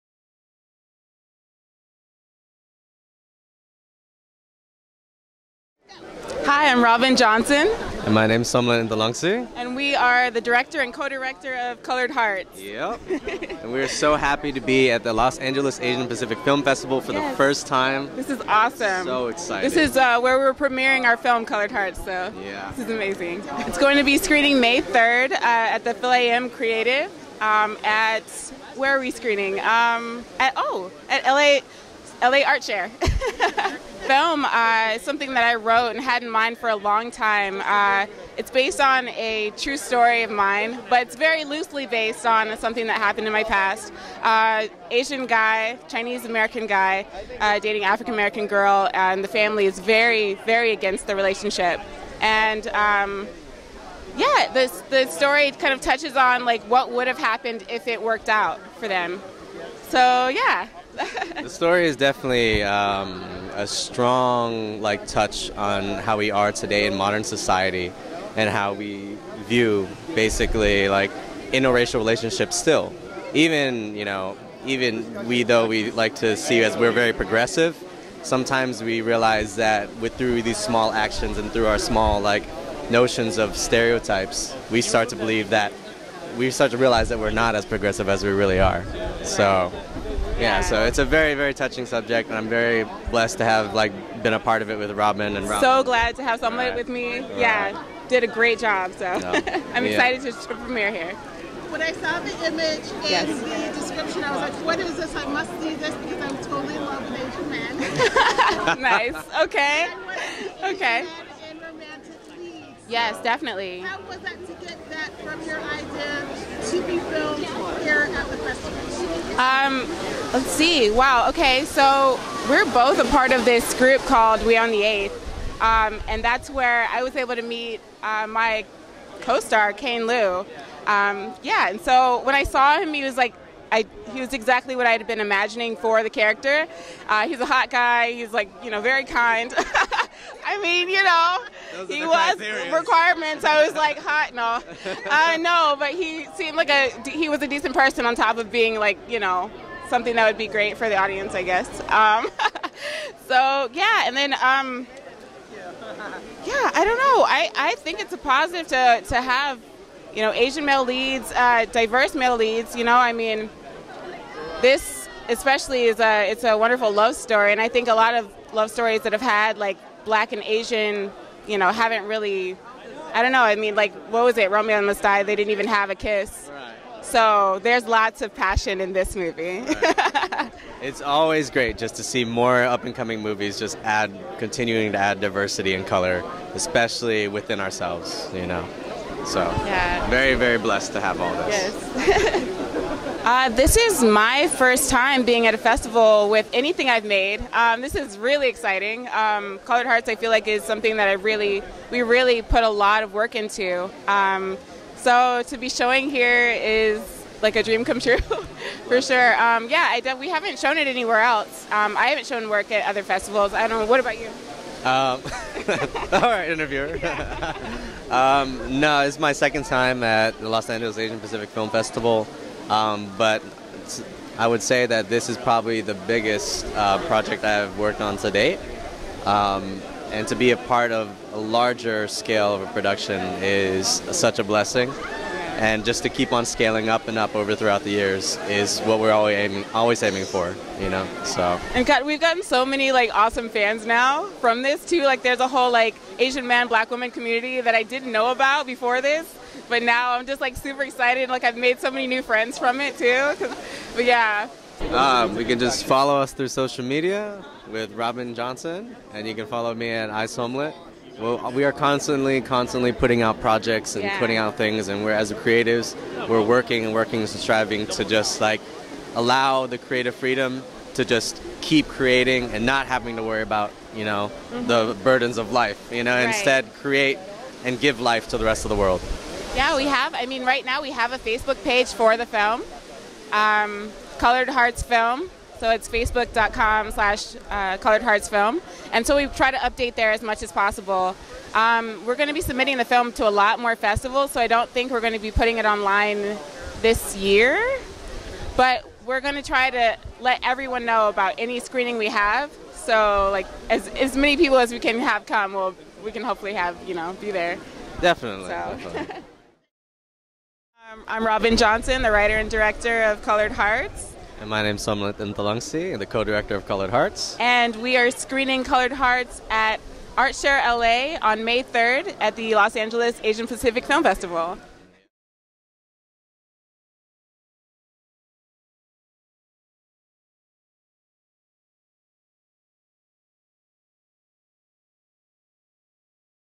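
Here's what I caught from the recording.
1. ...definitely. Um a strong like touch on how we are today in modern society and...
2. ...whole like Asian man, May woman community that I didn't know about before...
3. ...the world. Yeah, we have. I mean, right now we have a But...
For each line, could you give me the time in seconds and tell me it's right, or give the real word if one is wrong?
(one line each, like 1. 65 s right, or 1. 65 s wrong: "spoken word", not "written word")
1. 61 s right
2. 245 s wrong: "Black", not "May"
3. 278 s wrong: "Facebook", not "But".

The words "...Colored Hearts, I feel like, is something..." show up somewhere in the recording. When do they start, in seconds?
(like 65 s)
199 s.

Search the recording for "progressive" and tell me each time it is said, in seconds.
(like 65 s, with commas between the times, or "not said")
77 s, 87 s.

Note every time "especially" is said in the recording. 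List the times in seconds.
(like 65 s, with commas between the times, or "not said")
165 s, 186 s.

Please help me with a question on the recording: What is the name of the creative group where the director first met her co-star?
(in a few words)
We on the Eighth.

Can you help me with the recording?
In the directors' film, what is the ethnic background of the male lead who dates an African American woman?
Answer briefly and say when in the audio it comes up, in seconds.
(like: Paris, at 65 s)
Chinese American, at 45 s.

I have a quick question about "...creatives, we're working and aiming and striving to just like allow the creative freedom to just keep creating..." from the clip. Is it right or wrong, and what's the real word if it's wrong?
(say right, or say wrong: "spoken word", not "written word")
wrong: "working", not "aiming".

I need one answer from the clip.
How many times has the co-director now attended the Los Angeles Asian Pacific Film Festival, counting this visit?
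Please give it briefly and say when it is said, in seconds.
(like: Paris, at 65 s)
2, at 219 s.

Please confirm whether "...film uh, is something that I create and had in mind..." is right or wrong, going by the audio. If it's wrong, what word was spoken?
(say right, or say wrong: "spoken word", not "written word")
wrong: "wrote", not "create".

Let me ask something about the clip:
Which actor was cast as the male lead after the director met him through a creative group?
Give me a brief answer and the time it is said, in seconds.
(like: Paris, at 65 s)
Kane Lieu, at 129 s.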